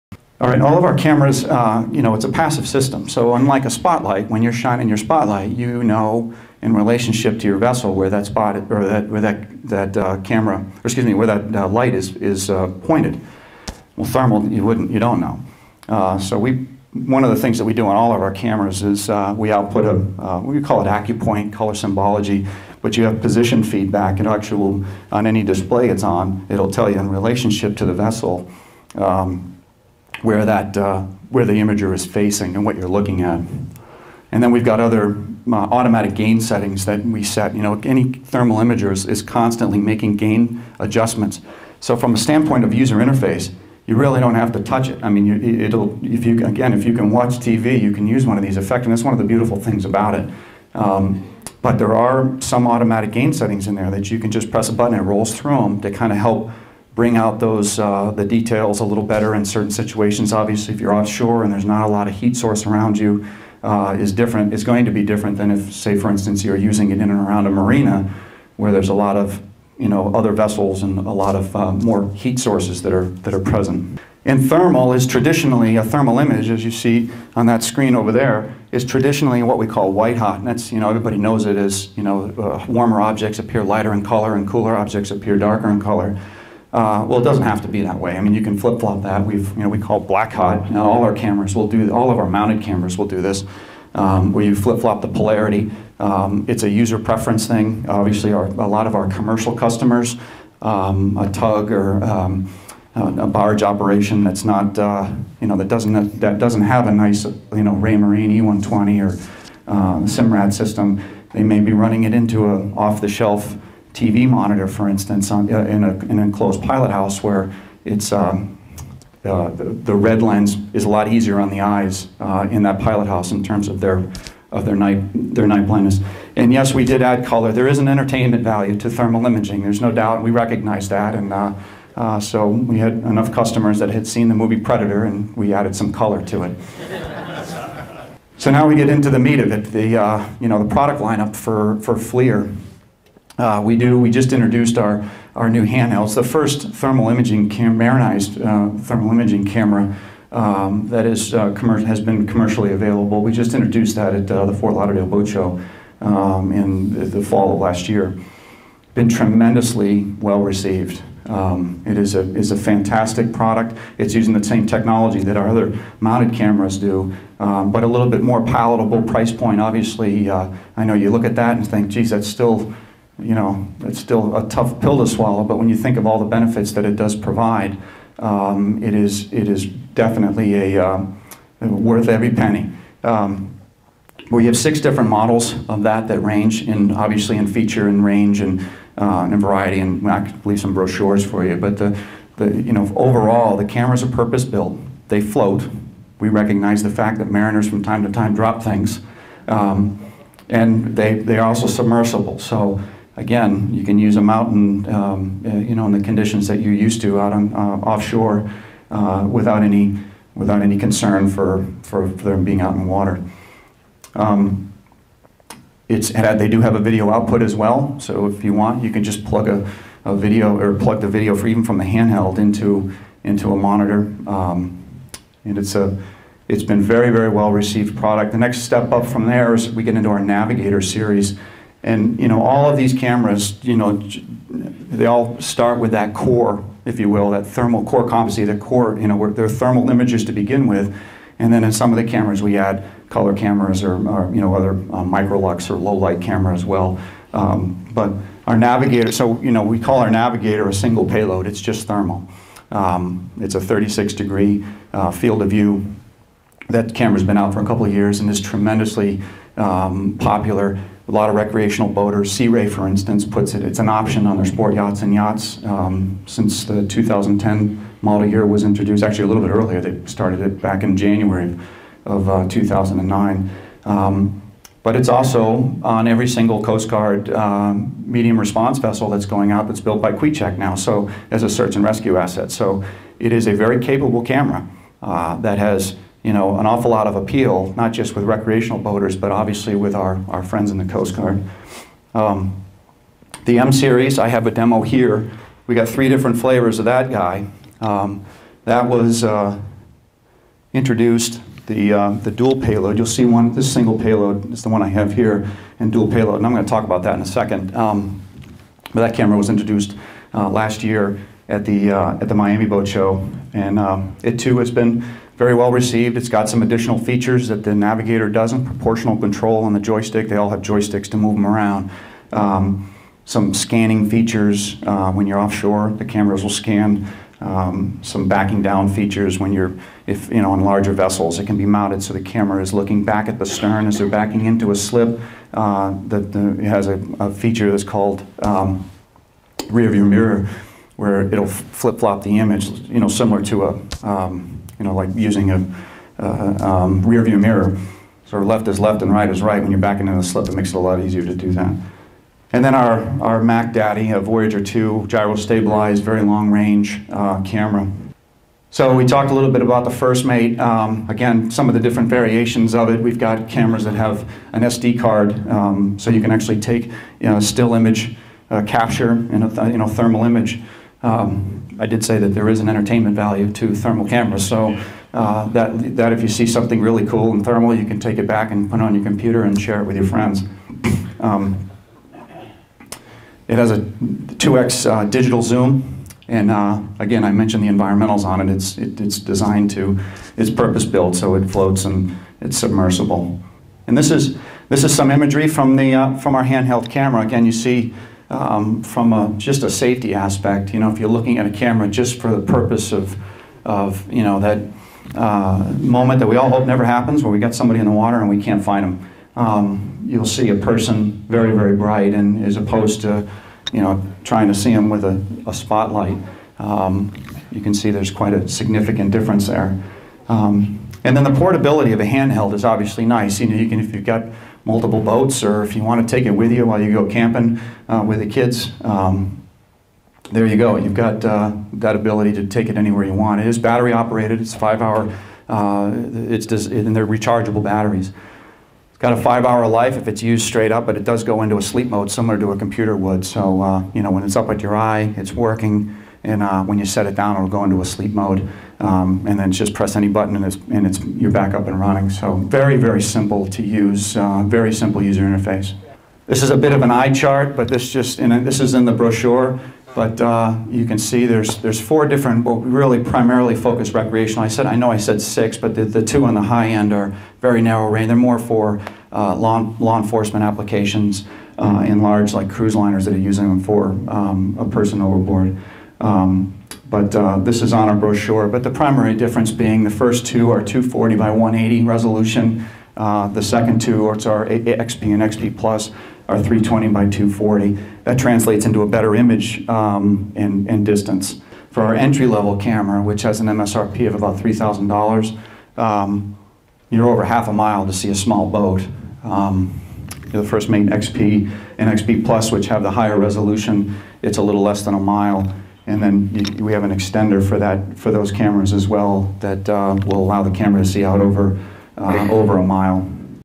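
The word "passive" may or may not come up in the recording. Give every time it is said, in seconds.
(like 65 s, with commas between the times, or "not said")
2 s.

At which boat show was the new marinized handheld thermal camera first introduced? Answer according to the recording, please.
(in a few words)
Fort Lauderdale Boat Show.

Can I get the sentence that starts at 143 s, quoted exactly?
Uh, we do, we just introduced our, our new handheld.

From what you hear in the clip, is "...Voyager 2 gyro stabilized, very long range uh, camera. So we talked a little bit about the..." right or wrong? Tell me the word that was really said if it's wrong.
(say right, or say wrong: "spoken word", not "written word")
right.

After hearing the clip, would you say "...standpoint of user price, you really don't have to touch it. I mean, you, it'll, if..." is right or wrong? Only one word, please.
wrong.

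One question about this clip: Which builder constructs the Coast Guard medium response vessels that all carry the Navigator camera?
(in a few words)
Kvichak.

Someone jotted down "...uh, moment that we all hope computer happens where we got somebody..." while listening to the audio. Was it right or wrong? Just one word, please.
wrong.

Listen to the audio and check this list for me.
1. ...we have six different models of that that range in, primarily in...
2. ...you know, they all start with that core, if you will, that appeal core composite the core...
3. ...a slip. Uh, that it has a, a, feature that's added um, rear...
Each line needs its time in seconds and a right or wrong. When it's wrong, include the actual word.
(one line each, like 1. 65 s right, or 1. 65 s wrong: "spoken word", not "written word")
1. 184 s wrong: "obviously", not "primarily"
2. 233 s wrong: "thermal", not "appeal"
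3. 334 s wrong: "called", not "added".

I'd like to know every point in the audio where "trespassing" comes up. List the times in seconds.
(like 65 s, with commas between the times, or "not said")
not said.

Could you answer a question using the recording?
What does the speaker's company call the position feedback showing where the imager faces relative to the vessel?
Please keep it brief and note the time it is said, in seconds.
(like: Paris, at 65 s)
AccuPoint color symbology, at 20 s.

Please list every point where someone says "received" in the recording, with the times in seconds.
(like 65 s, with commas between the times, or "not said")
160 s, 227 s, 315 s.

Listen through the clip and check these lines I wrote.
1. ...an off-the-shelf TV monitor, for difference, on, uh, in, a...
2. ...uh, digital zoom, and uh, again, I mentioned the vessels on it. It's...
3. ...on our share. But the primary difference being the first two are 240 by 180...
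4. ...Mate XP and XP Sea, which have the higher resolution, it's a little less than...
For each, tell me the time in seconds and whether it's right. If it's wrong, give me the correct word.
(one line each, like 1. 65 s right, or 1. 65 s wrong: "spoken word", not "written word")
1. 112 s wrong: "instance", not "difference"
2. 384 s wrong: "environmentals", not "vessels"
3. 477 s wrong: "brochure", not "share"
4. 500 s wrong: "Plus", not "Sea".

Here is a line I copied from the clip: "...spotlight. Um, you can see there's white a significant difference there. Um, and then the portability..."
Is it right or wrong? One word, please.
wrong.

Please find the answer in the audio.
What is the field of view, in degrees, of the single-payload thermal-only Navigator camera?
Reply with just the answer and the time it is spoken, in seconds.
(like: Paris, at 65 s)
36 degrees, at 253 s.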